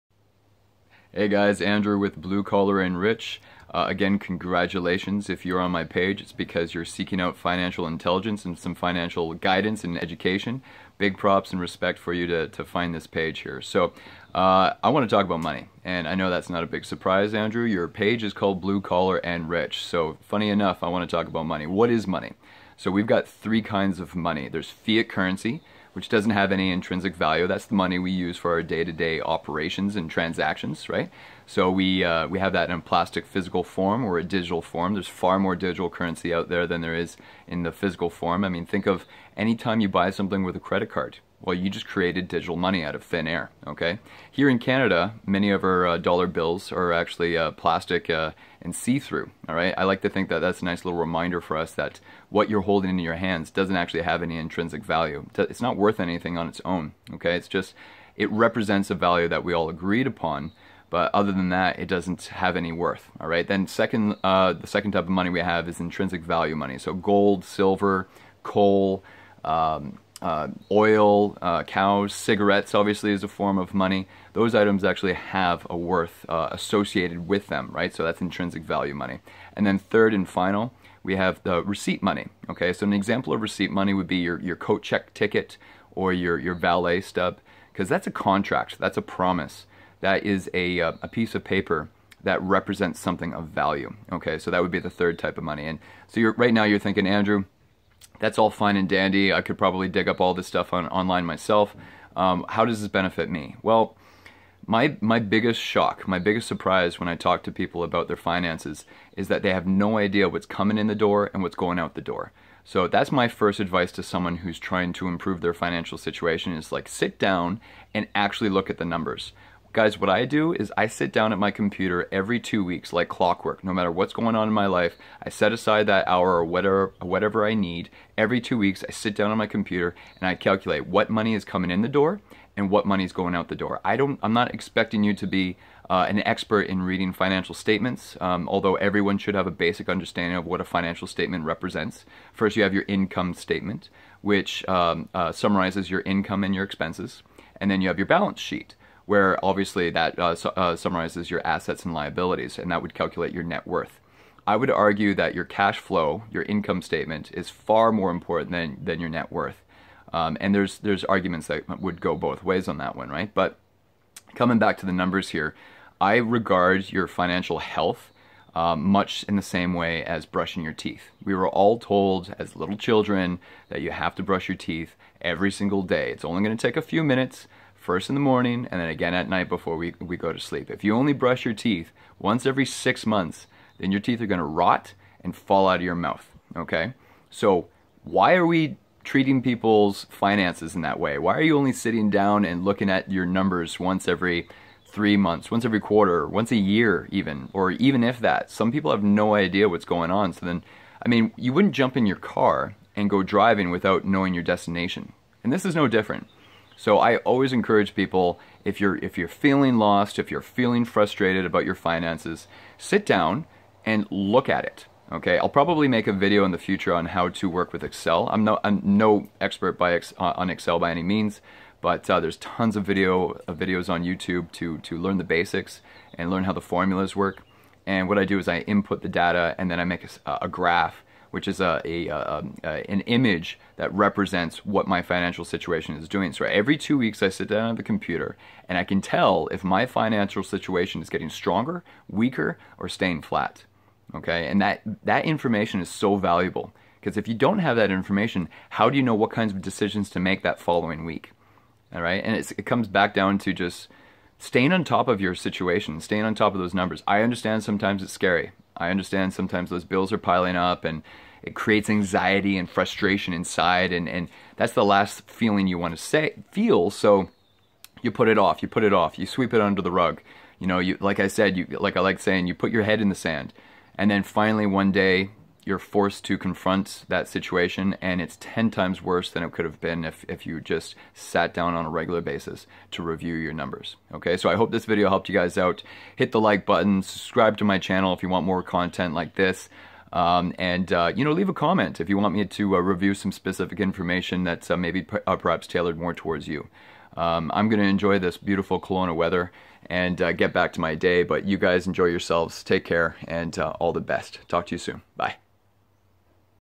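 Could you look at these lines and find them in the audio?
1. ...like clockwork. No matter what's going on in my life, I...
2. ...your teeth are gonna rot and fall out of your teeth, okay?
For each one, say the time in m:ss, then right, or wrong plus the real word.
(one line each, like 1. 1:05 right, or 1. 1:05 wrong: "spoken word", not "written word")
1. 2:02 right
2. 3:03 wrong: "mouth", not "teeth".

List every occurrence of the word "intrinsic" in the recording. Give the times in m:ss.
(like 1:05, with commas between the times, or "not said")
0:26, 0:54, 1:05, 1:18.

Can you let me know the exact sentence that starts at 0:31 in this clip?
So we, uh, we have that in a plastic physical form or a digital form.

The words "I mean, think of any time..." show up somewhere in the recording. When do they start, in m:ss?
0:38.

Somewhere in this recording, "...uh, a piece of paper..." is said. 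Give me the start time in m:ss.
1:30.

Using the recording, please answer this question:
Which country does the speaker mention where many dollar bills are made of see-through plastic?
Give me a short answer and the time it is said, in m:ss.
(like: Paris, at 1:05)
Canada, at 0:44.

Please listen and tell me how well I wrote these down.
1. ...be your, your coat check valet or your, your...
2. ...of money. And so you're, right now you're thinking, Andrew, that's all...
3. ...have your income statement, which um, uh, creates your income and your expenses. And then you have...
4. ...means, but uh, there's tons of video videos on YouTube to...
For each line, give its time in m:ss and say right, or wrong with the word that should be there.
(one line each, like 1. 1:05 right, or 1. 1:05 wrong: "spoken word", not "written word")
1. 1:24 wrong: "ticket", not "valet"
2. 1:35 right
3. 2:22 wrong: "summarizes", not "creates"
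4. 3:41 right.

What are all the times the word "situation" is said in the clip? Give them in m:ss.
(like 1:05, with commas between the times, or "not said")
1:55, 3:55, 4:00, 4:15, 4:37.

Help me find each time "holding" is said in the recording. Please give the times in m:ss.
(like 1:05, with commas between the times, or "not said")
0:52.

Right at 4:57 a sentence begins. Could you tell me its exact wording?
Um, I'm going to enjoy this beautiful Kelowna weather and uh, get back to my day, but you guys enjoy yourselves.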